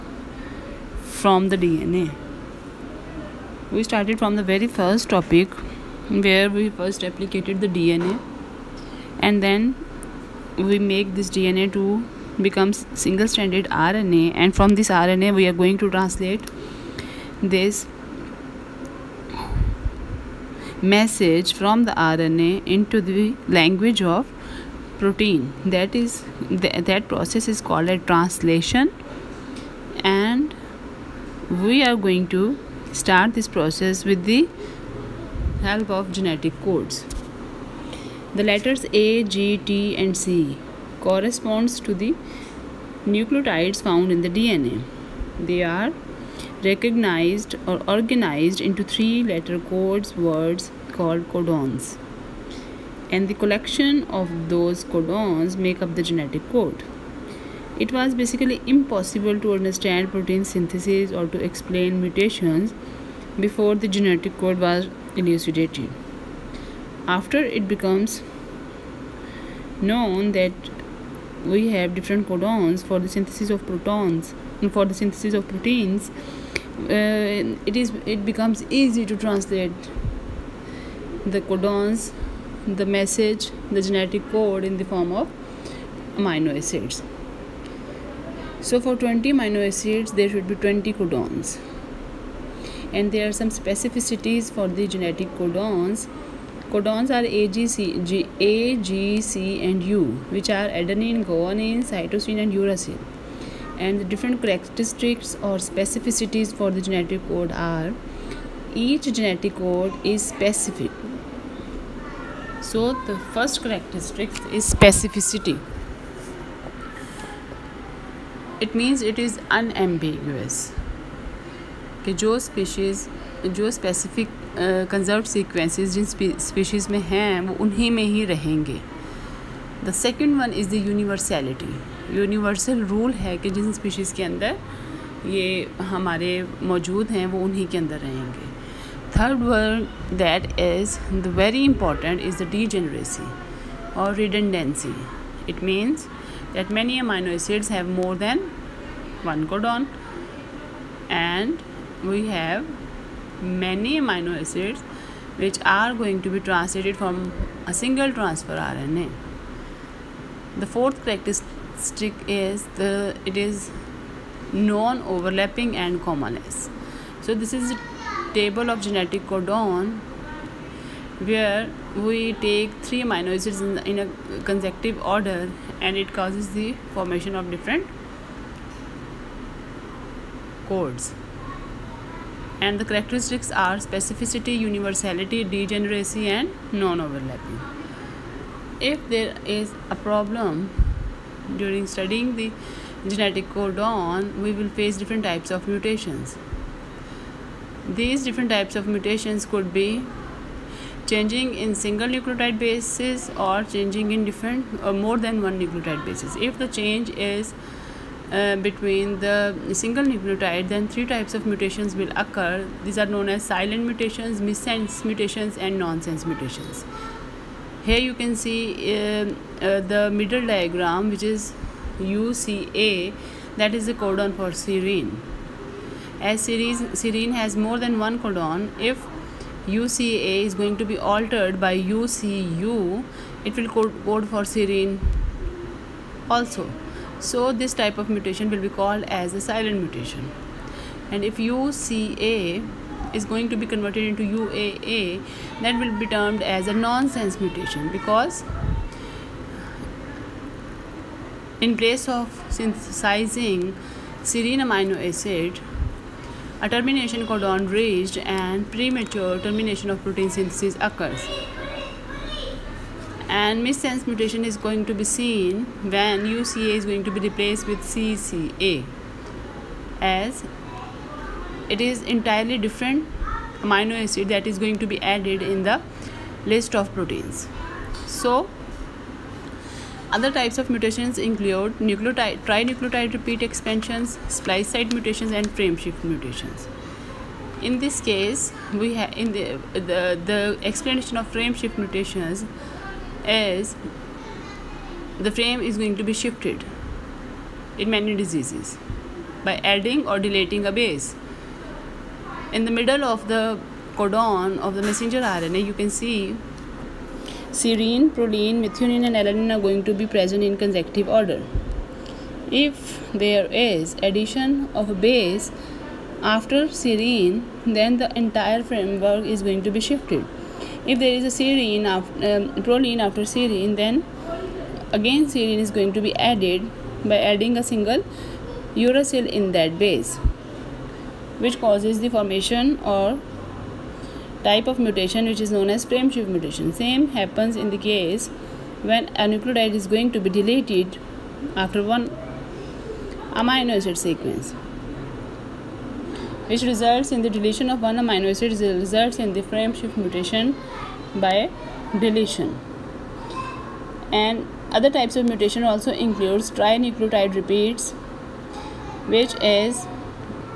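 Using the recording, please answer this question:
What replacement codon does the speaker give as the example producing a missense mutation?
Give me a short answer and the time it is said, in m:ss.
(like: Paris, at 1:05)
CCA, at 4:27.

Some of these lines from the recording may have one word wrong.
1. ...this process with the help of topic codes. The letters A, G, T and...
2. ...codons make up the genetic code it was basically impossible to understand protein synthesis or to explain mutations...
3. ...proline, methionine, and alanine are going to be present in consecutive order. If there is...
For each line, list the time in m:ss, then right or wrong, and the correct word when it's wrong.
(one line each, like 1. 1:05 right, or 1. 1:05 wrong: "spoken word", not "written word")
1. 0:33 wrong: "genetic", not "topic"
2. 0:54 right
3. 5:08 right.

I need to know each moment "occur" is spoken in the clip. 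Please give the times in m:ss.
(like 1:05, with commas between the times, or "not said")
3:32, 4:20.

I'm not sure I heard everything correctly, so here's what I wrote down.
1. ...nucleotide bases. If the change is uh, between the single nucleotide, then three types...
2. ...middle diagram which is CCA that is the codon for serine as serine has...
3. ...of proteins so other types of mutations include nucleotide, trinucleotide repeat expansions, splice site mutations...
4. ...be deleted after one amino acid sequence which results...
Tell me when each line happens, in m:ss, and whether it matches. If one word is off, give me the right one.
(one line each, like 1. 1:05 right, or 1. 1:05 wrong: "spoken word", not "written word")
1. 3:25 right
2. 3:40 wrong: "UCA", not "CCA"
3. 4:36 right
4. 5:40 right.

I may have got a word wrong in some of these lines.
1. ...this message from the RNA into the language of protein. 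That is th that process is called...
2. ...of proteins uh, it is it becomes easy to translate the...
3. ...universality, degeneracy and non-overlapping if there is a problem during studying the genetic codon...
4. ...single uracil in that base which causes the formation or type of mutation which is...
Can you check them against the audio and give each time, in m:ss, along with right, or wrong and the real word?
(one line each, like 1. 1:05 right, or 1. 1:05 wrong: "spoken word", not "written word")
1. 0:17 right
2. 1:15 right
3. 3:04 right
4. 5:27 right.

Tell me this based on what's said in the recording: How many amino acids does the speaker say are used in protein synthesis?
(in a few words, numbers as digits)
20.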